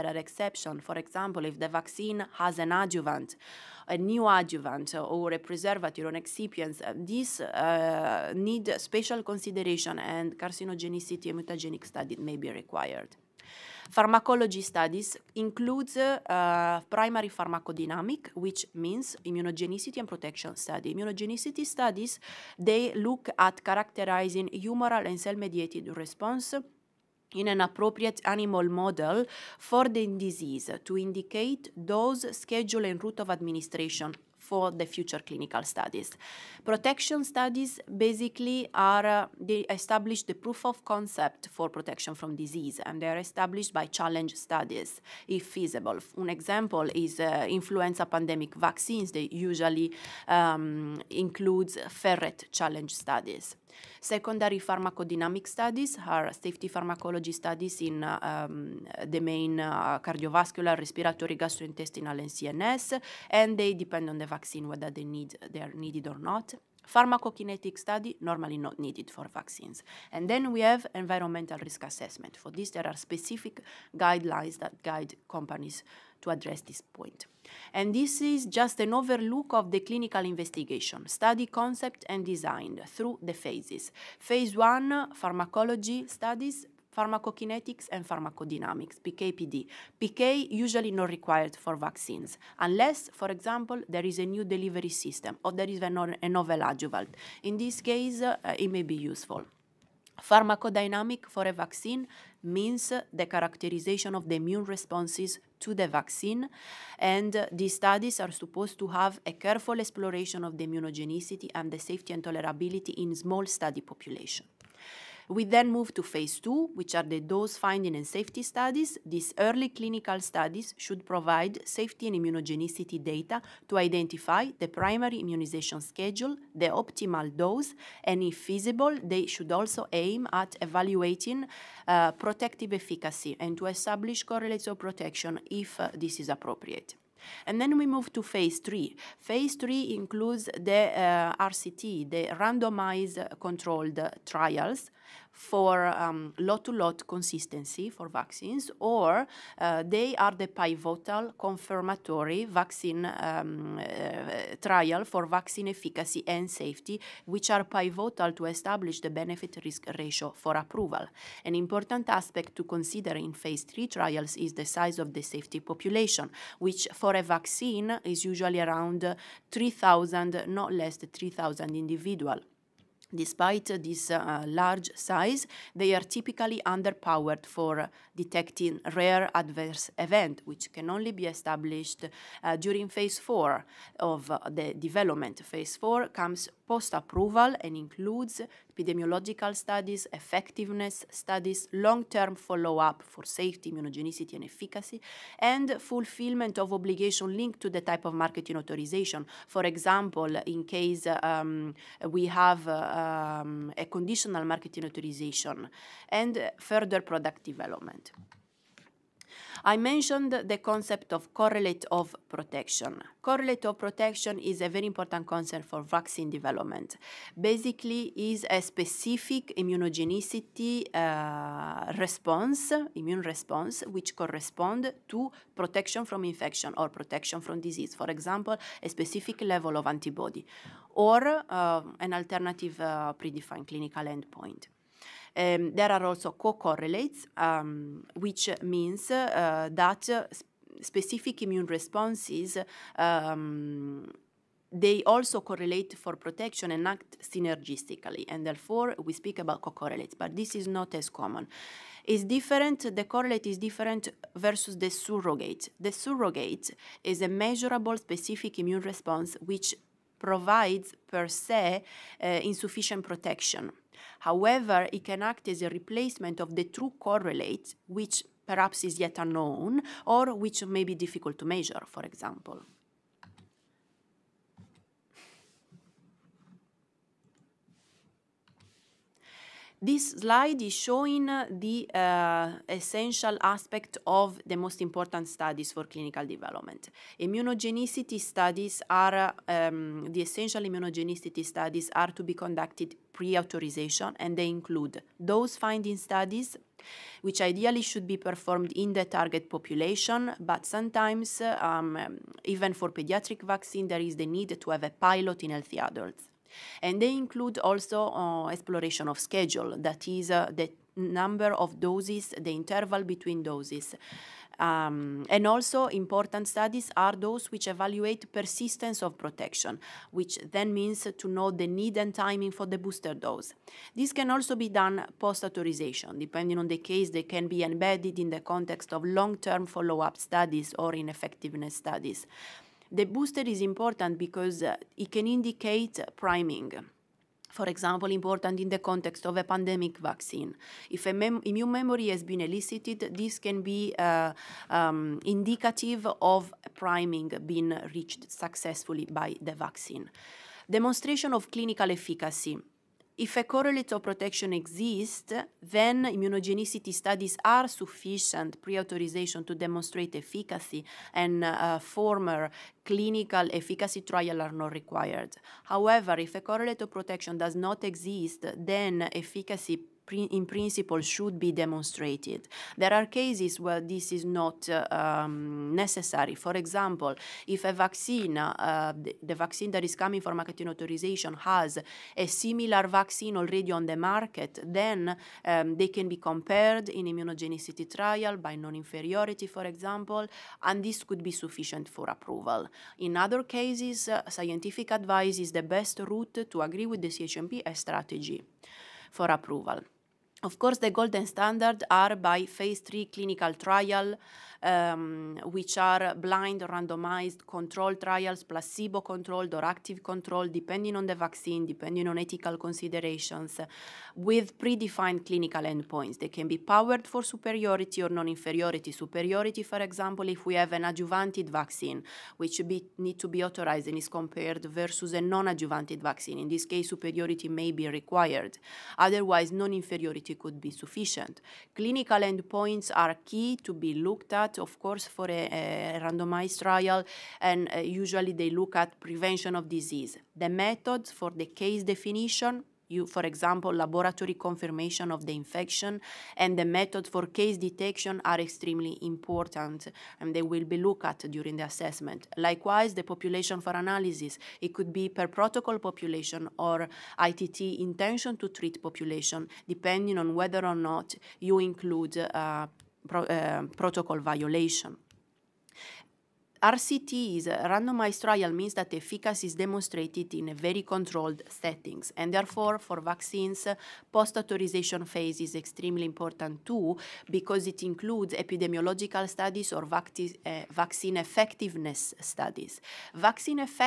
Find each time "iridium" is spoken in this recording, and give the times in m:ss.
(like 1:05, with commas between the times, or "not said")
not said.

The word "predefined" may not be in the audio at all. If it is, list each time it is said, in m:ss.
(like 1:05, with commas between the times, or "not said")
3:53, 6:54.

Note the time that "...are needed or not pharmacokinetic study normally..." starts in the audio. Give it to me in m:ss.
1:05.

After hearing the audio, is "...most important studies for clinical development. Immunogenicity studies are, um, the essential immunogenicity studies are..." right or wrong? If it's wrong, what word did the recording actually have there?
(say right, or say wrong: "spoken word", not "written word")
right.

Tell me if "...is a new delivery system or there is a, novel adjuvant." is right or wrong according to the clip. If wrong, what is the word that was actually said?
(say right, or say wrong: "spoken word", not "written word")
right.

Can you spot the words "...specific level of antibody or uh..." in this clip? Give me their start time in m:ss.
3:48.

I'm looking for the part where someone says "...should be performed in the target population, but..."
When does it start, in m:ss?
4:57.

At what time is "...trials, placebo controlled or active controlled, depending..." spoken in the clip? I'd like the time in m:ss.
6:47.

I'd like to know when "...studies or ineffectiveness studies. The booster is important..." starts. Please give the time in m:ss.
5:30.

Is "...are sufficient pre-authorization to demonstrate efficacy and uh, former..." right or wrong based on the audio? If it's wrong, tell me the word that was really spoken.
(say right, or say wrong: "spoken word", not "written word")
right.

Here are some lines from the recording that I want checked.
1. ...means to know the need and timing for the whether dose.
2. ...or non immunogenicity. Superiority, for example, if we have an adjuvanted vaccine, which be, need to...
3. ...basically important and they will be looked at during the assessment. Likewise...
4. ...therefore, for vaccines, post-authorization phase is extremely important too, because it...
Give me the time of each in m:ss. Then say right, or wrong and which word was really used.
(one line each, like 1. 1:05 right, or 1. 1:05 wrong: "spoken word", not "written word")
1. 5:20 wrong: "booster", not "whether"
2. 6:58 wrong: "inferiority", not "immunogenicity"
3. 7:28 wrong: "extremely", not "basically"
4. 7:52 right.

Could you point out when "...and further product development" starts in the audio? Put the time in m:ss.
3:26.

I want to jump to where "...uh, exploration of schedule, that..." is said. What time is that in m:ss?
5:08.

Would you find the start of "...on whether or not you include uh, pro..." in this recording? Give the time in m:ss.
7:40.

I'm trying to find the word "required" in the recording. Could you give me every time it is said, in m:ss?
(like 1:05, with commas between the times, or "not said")
0:12, 1:31, 6:04, 7:07.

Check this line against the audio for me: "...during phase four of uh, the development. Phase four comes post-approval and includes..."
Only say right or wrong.
right.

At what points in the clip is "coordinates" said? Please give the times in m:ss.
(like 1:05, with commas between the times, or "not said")
not said.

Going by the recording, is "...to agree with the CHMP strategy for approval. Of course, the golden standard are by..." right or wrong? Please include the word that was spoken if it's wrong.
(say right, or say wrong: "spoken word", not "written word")
right.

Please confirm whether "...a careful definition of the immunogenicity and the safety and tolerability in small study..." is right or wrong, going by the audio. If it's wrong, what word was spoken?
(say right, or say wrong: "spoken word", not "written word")
wrong: "exploration", not "definition".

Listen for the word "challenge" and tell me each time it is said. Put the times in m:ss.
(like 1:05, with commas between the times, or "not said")
0:43, 0:52.